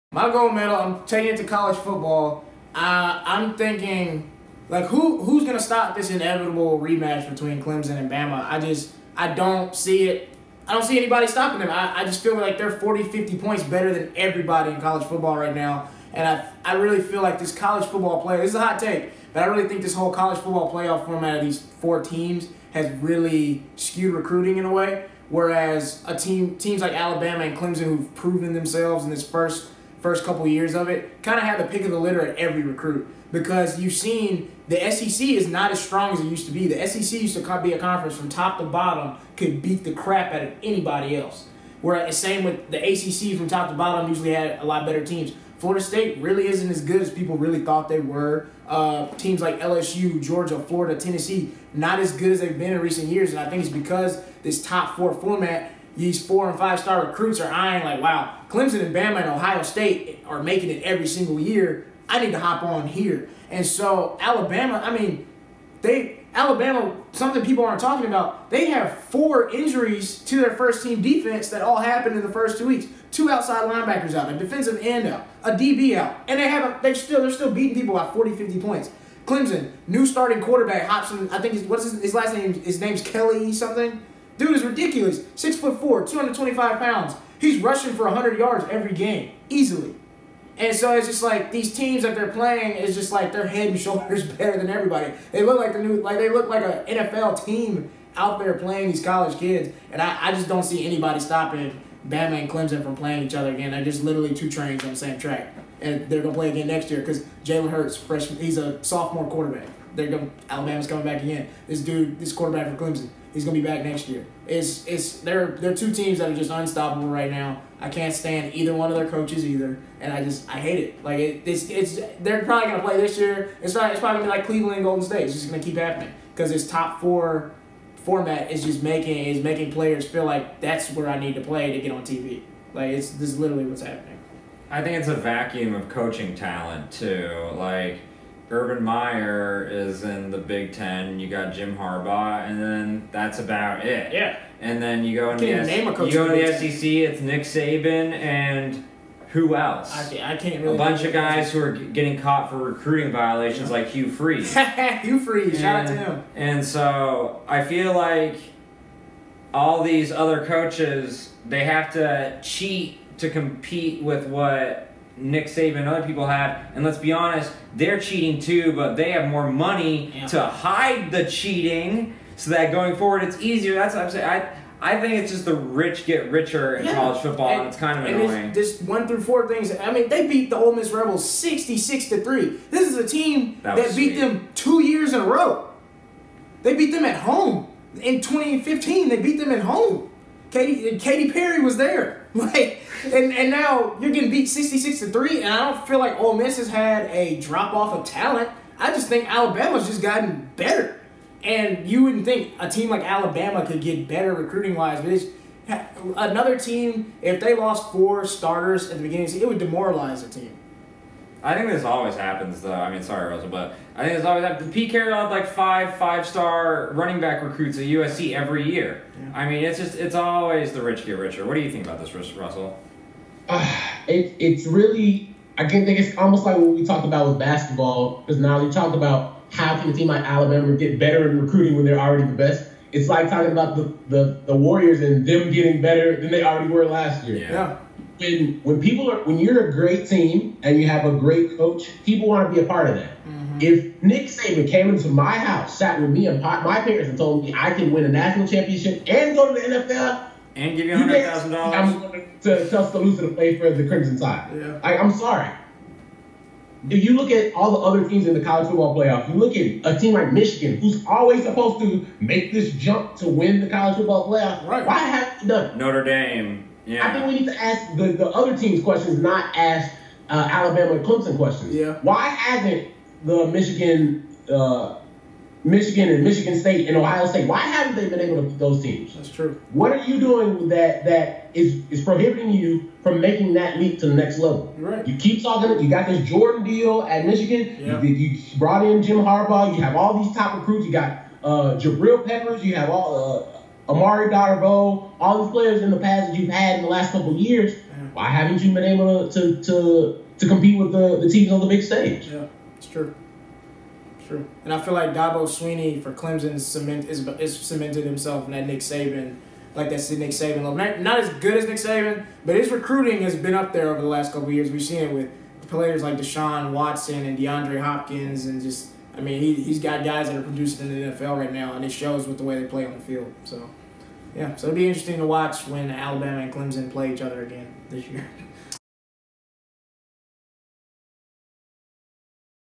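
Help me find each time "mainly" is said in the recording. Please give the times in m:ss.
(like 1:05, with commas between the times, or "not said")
not said.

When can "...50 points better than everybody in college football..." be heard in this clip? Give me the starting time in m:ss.
0:13.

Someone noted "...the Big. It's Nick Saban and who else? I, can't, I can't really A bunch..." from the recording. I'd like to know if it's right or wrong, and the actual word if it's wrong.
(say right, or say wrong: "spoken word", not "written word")
wrong: "SEC", not "Big".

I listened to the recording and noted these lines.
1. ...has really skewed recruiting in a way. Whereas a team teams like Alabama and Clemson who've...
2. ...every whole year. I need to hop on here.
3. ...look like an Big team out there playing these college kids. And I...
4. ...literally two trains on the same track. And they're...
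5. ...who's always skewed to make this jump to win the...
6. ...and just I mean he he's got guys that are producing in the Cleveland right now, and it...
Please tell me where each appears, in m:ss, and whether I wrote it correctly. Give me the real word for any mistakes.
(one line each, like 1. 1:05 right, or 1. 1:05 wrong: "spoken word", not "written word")
1. 0:22 right
2. 1:00 wrong: "single", not "whole"
3. 1:36 wrong: "NFL", not "Big"
4. 1:44 right
5. 4:20 wrong: "supposed", not "skewed"
6. 5:18 wrong: "NFL", not "Cleveland".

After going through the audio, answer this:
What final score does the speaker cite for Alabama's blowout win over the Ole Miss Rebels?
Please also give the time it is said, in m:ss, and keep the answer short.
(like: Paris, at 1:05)
66-3, at 3:01.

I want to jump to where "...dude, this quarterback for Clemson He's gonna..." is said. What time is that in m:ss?
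1:51.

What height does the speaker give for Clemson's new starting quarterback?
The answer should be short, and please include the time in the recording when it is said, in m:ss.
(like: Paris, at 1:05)
6 foot 4, at 1:25.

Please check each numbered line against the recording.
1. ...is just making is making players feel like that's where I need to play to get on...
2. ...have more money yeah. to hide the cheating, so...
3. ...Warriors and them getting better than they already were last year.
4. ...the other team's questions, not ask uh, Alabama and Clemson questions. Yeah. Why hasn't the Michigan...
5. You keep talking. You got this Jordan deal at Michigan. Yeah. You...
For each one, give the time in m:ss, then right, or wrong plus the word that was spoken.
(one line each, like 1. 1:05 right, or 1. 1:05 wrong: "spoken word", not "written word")
1. 2:08 right
2. 2:49 right
3. 3:54 right
4. 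4:28 right
5. 4:45 right.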